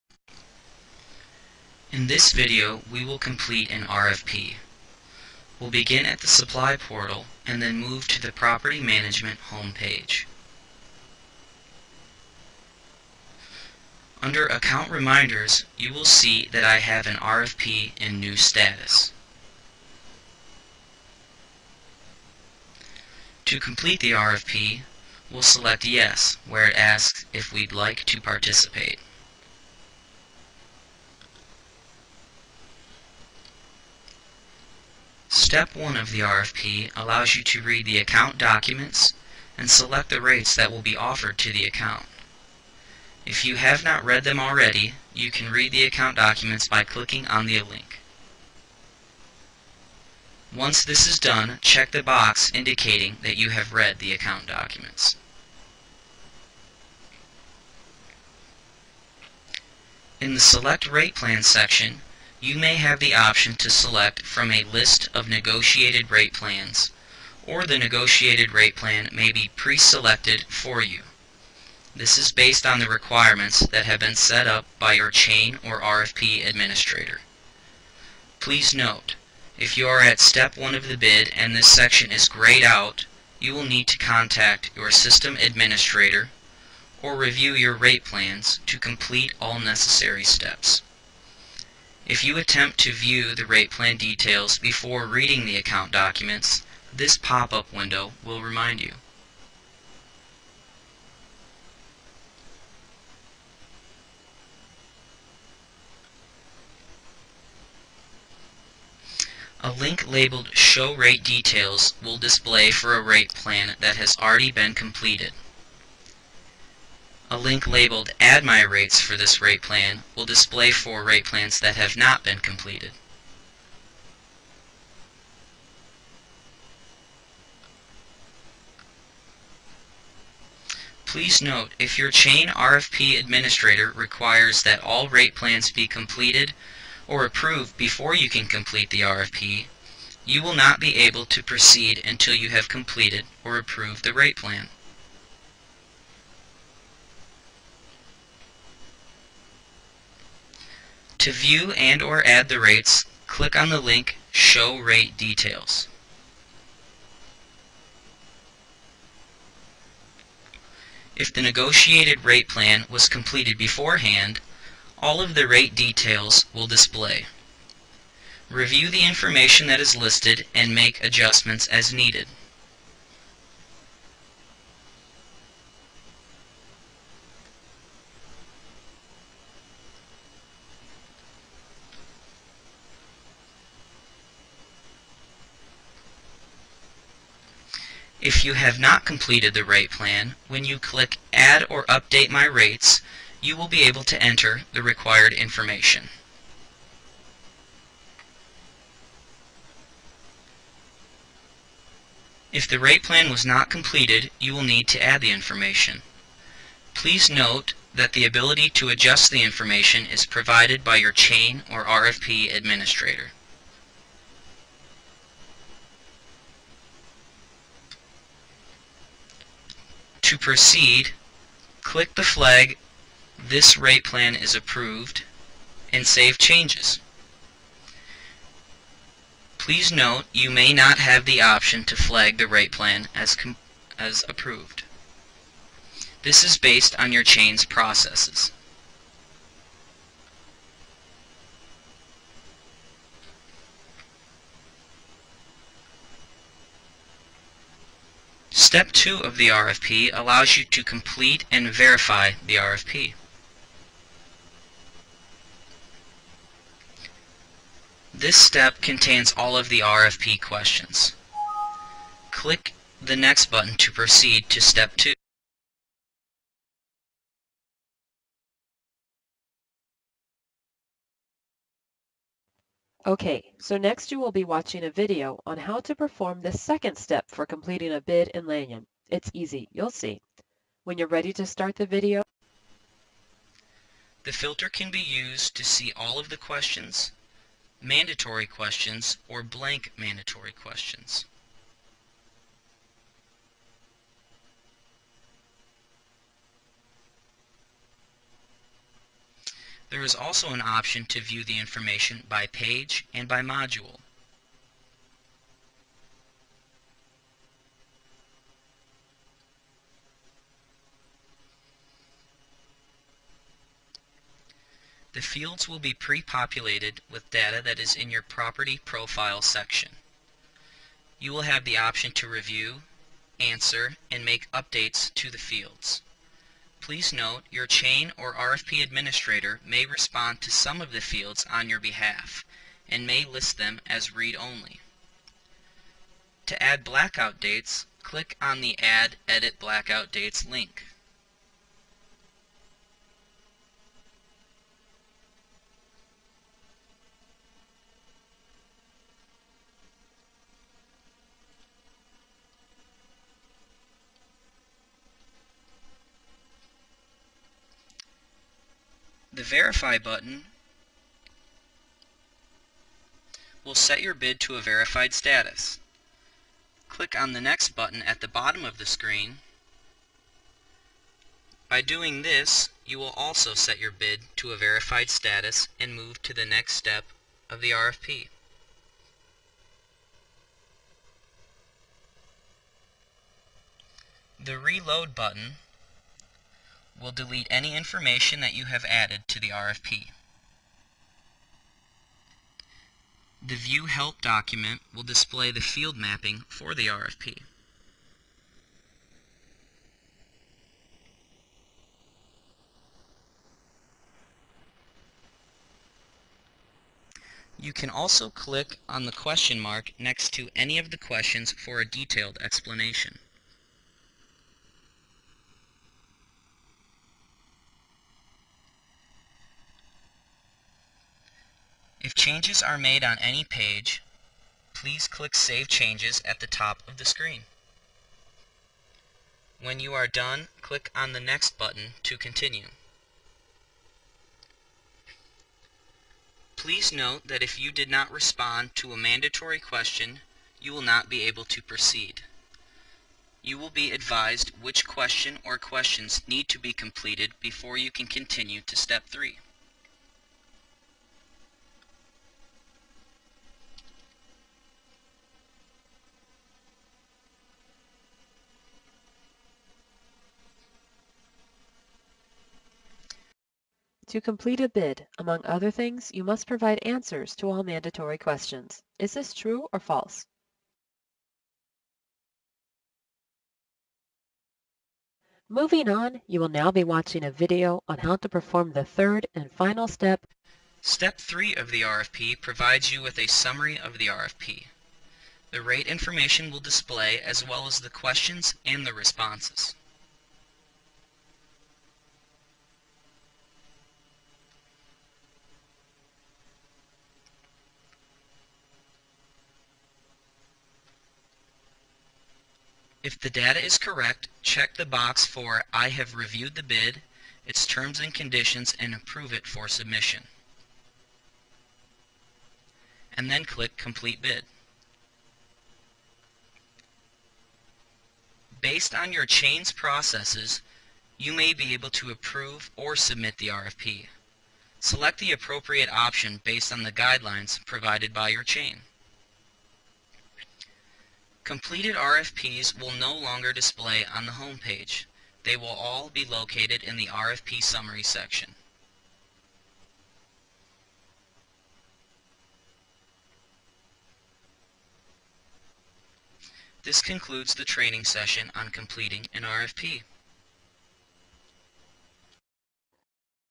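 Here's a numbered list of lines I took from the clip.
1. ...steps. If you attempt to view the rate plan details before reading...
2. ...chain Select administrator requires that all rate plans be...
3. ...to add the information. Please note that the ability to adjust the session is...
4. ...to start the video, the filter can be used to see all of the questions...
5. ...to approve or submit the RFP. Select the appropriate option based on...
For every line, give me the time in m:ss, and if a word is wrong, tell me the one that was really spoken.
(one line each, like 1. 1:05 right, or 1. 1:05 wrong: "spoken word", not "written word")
1. 1:30 right
2. 2:12 wrong: "RFP", not "Select"
3. 3:24 wrong: "information", not "session"
4. 4:41 right
5. 8:41 right.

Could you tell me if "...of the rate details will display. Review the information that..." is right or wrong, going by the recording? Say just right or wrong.
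right.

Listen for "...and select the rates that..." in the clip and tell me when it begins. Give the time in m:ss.
0:39.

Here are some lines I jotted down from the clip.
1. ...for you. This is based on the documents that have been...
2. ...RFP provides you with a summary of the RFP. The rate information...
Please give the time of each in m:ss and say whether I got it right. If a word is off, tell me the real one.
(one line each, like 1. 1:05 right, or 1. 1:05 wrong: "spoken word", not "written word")
1. 1:10 wrong: "requirements", not "documents"
2. 8:01 right.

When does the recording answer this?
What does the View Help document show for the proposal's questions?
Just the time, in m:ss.
6:35.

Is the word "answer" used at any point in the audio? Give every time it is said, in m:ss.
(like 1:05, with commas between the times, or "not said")
5:23, 7:46.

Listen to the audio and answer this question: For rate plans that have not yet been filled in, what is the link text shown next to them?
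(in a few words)
Add My Rates.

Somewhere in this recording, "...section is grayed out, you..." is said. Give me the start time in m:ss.
1:21.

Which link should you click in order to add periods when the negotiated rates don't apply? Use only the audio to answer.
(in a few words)
Add Edit Blackout Dates.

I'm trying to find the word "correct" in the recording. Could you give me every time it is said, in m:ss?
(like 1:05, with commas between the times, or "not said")
8:23.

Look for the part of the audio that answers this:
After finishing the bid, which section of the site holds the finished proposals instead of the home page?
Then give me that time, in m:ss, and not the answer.
8:57.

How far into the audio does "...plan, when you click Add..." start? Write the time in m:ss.
3:09.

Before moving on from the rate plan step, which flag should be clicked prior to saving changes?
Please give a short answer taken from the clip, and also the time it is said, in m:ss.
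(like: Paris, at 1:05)
This Rate Plan is Approved, at 3:43.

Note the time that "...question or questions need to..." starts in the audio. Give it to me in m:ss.
7:24.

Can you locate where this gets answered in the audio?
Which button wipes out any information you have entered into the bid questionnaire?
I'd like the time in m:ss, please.
6:24.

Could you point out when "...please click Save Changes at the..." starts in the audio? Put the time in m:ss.
7:04.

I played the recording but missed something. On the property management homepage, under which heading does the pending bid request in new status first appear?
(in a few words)
Account reminders.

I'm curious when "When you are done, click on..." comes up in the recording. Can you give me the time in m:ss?
7:09.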